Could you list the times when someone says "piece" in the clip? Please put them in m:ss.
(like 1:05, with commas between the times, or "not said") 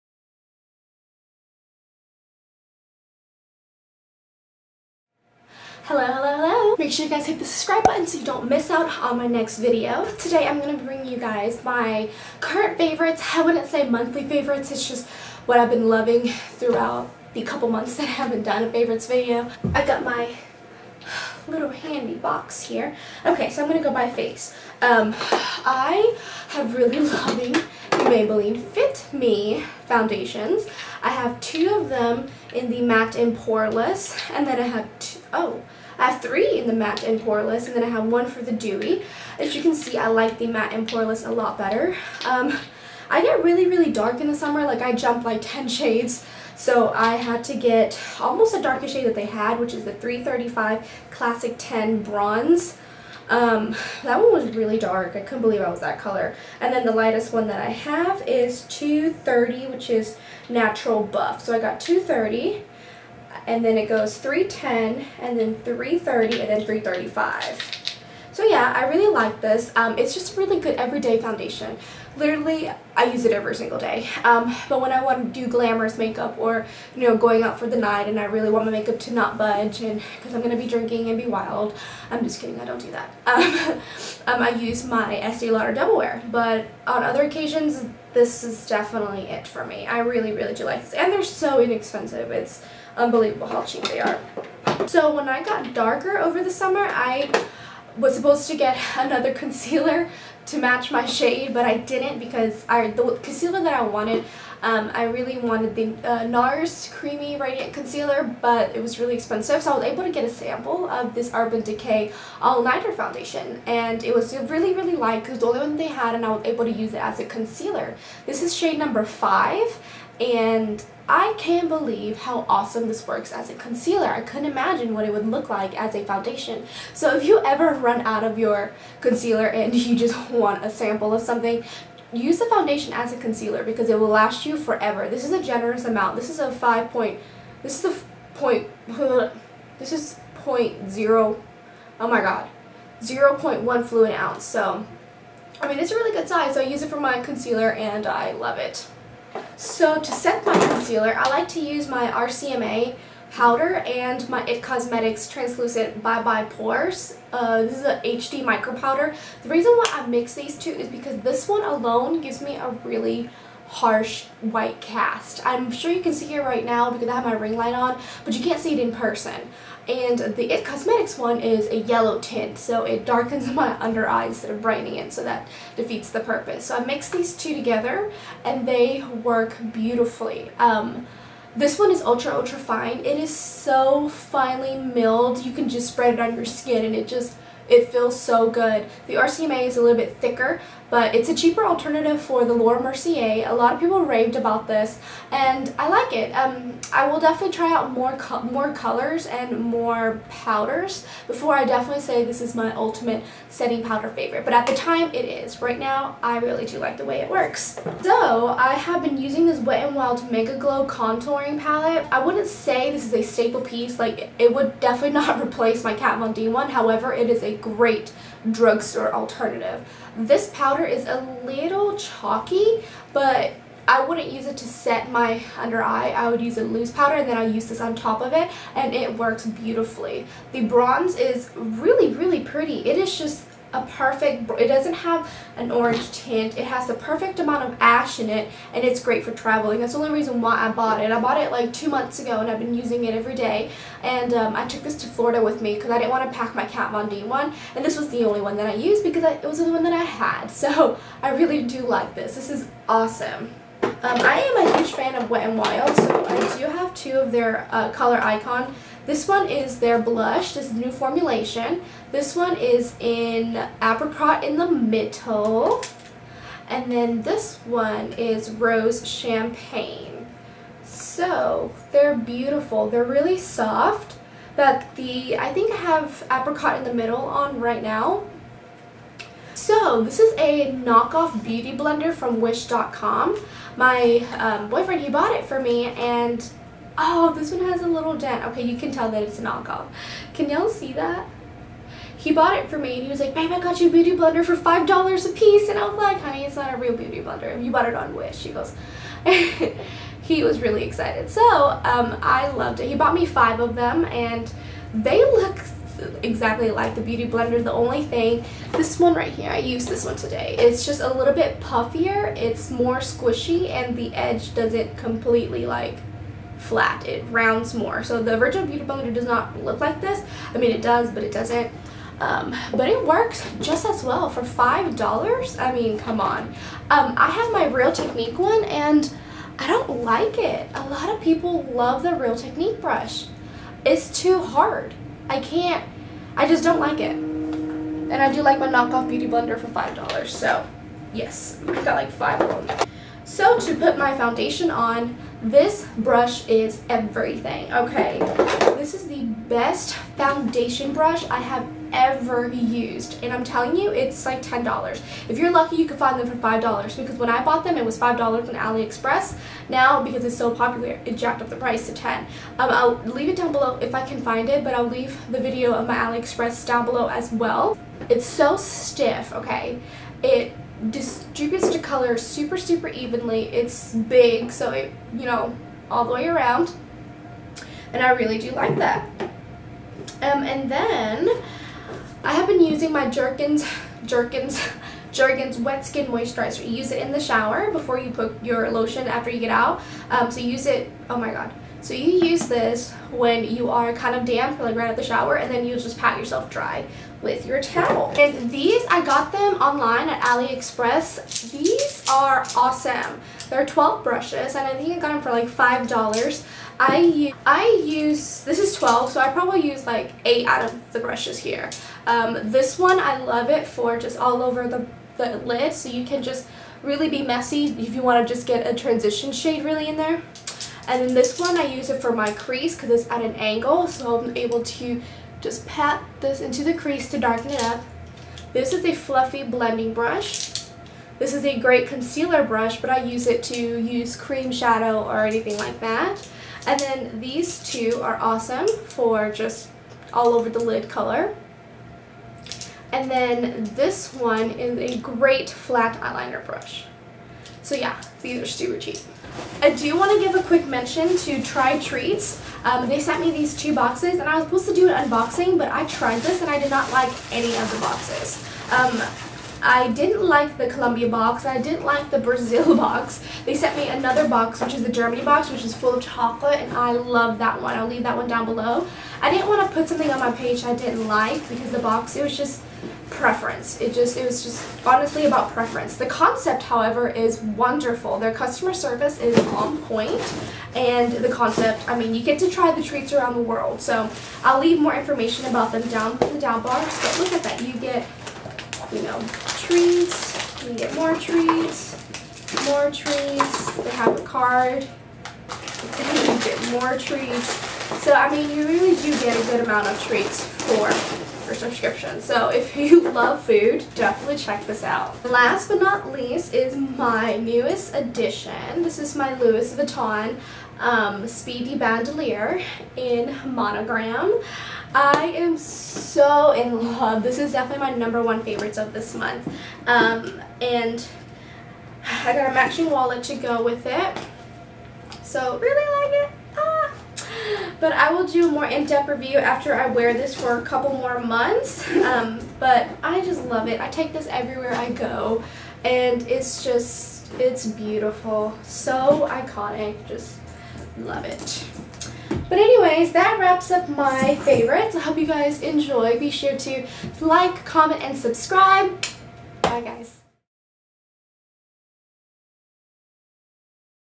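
3:33, 4:55.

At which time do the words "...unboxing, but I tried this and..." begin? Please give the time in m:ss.
7:35.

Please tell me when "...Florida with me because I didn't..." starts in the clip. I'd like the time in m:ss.
4:05.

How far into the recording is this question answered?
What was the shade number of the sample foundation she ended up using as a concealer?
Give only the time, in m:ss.
1:58.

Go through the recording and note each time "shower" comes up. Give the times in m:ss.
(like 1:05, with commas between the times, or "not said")
6:27, 6:35.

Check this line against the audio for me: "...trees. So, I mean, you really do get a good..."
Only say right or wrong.
right.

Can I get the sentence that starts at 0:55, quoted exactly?
I couldn't believe I was that color.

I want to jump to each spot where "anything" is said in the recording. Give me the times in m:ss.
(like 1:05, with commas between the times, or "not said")
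7:15.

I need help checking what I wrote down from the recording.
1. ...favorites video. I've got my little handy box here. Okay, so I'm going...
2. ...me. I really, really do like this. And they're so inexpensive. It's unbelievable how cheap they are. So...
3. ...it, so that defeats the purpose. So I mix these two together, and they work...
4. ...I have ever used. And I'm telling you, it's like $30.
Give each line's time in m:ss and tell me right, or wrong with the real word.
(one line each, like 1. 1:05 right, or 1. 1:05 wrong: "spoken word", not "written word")
1. 0:18 right
2. 1:29 right
3. 2:54 right
4. 5:51 wrong: "10", not "30".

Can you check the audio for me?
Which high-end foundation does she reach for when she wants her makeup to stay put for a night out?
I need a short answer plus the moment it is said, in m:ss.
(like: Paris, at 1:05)
Estee Lauder Double Wear, at 1:25.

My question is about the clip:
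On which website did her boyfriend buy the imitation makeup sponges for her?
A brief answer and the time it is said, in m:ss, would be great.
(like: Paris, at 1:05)
Wish.com, at 4:42.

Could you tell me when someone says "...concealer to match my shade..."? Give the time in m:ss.
1:39.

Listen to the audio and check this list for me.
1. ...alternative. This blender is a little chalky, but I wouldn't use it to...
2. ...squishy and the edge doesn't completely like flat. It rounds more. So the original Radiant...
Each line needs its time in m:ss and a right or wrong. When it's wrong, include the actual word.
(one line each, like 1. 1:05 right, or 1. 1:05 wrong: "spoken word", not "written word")
1. 3:39 wrong: "powder", not "blender"
2. 5:12 wrong: "Beauty", not "Radiant".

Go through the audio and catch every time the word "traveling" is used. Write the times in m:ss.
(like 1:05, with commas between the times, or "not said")
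3:59.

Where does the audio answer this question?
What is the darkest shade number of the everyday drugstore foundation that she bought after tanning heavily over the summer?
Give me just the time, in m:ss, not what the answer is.
0:49.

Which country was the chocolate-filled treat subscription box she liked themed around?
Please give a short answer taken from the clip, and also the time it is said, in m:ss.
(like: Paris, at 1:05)
Germany, at 7:44.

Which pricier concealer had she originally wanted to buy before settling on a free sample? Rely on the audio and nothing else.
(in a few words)
NARS Creamy Radiant Concealer.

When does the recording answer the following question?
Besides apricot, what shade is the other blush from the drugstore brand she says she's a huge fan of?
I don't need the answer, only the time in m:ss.
4:28.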